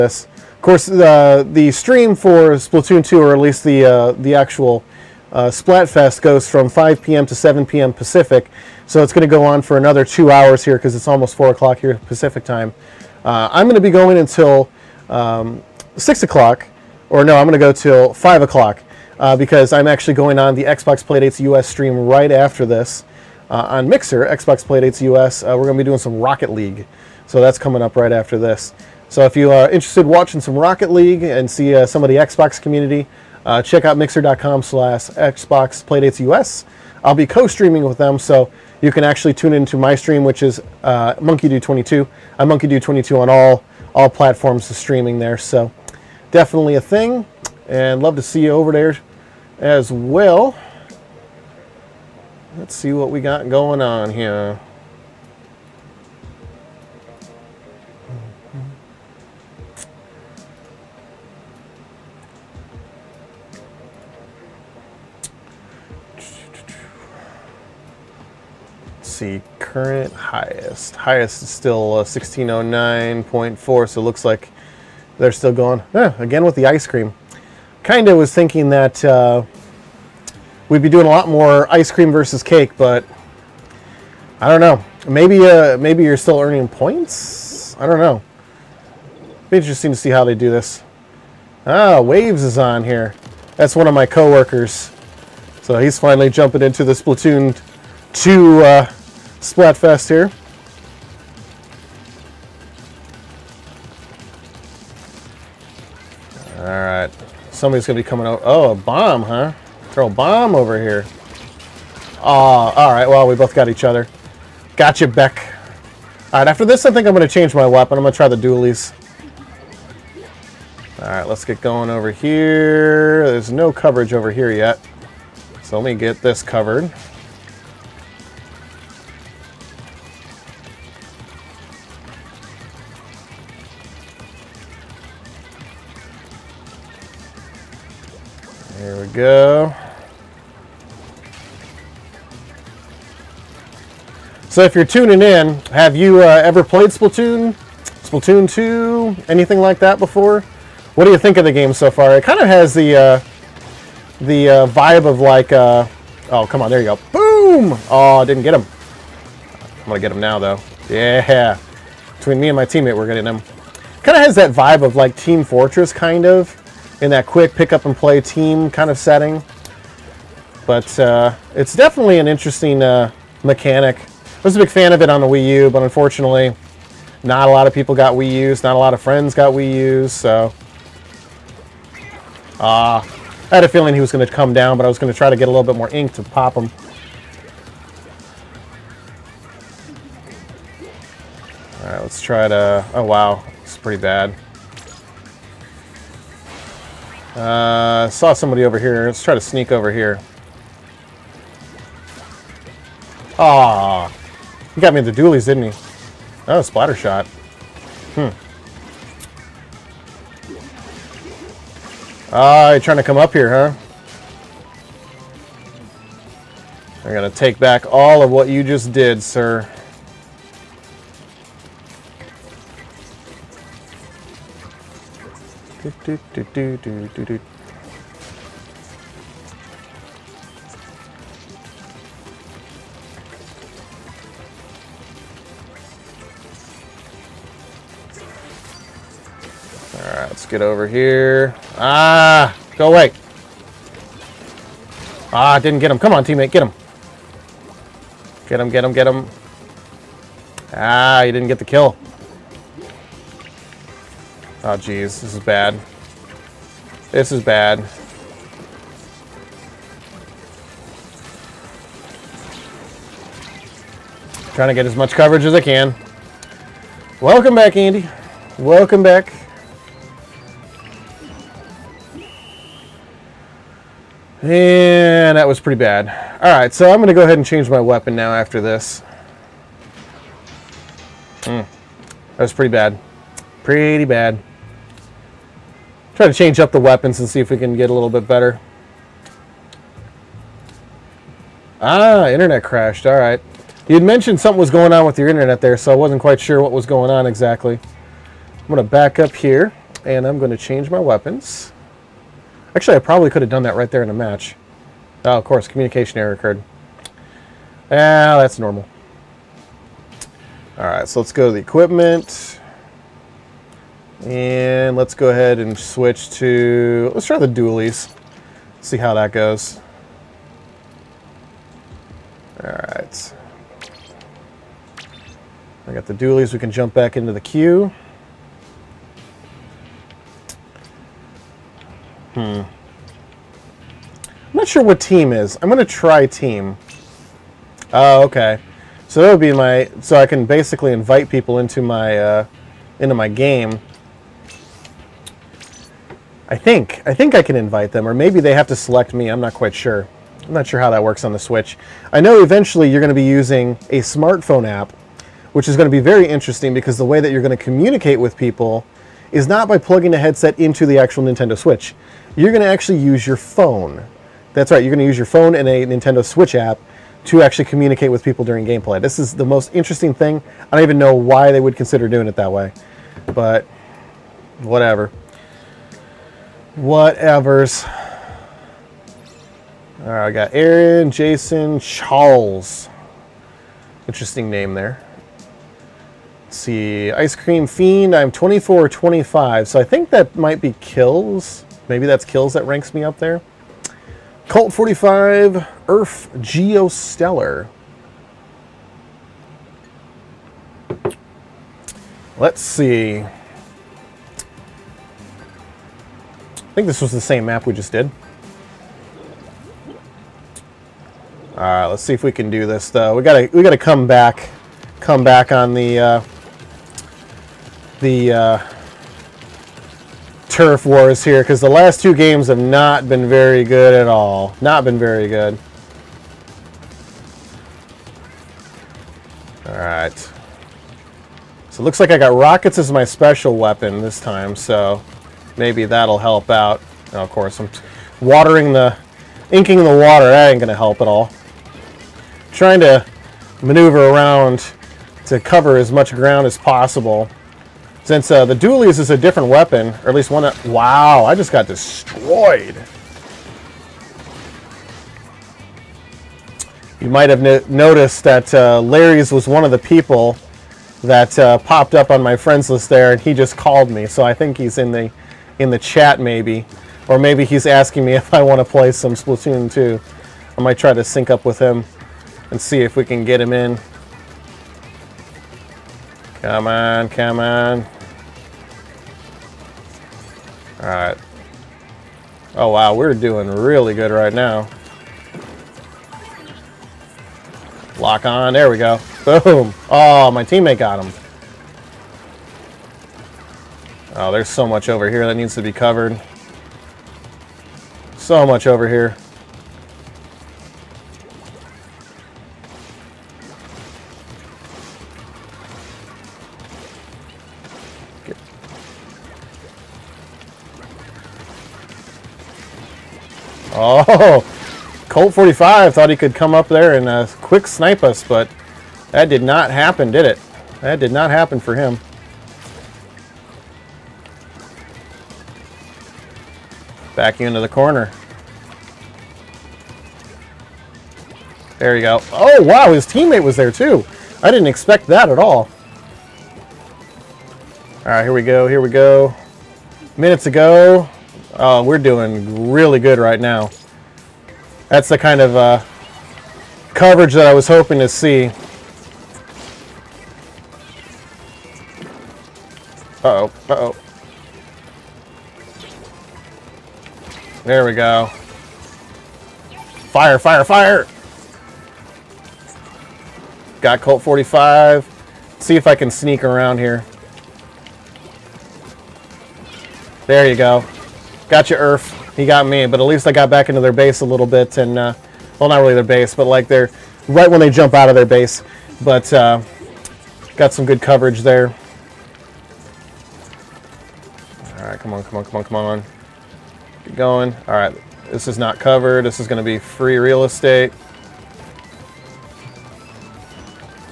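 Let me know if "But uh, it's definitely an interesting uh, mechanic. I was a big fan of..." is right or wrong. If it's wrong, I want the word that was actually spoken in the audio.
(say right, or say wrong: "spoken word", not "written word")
right.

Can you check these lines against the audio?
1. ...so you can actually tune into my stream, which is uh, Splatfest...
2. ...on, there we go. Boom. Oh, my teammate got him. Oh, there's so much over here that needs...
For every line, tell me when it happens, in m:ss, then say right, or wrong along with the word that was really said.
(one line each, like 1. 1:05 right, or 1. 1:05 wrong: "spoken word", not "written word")
1. 0:38 wrong: "MonkeyDude", not "Splatfest"
2. 8:08 right.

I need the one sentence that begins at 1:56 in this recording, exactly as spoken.
All right, after this, I think I'm gonna change my weapon.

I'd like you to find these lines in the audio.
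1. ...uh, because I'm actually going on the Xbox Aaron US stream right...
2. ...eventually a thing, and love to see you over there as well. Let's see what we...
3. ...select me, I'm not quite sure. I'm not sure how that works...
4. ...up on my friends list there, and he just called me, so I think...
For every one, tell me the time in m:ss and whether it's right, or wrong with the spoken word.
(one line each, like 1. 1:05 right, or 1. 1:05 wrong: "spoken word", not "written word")
1. 0:19 wrong: "Playdates", not "Aaron"
2. 0:46 wrong: "definitely", not "eventually"
3. 5:48 right
4. 7:41 right.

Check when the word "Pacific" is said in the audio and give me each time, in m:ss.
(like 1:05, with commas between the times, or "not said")
0:07, 0:12.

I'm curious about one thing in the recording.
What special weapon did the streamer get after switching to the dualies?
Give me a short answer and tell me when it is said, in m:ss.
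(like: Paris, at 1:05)
rockets, at 7:12.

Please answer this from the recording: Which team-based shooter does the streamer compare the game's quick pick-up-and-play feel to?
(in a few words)
Team Fortress.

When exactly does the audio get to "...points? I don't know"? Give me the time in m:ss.
1:26.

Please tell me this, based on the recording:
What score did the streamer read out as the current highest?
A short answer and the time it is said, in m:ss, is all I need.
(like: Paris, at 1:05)
1609.4, at 1:12.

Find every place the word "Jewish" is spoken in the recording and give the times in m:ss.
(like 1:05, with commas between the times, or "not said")
not said.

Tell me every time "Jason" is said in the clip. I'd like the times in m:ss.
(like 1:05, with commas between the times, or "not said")
6:21.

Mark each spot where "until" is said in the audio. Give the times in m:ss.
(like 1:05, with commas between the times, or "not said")
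0:14.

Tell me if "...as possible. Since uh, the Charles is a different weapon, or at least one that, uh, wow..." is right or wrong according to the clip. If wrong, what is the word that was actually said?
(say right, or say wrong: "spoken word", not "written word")
wrong: "Dualies", not "Charles".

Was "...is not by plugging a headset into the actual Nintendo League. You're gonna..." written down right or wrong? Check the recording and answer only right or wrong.
wrong.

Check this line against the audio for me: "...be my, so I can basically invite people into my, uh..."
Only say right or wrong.
right.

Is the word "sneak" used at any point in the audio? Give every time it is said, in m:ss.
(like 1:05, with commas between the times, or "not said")
3:19, 9:26.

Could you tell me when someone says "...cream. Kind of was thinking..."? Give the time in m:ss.
1:16.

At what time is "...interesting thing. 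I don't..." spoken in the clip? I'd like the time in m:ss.
6:09.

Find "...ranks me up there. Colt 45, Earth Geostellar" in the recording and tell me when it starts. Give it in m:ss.
6:32.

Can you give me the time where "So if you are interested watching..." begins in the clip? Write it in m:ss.
0:29.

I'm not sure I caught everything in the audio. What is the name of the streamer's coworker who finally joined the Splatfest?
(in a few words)
Waves.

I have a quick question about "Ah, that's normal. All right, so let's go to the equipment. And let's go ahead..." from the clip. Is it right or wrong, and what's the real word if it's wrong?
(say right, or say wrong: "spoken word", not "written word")
right.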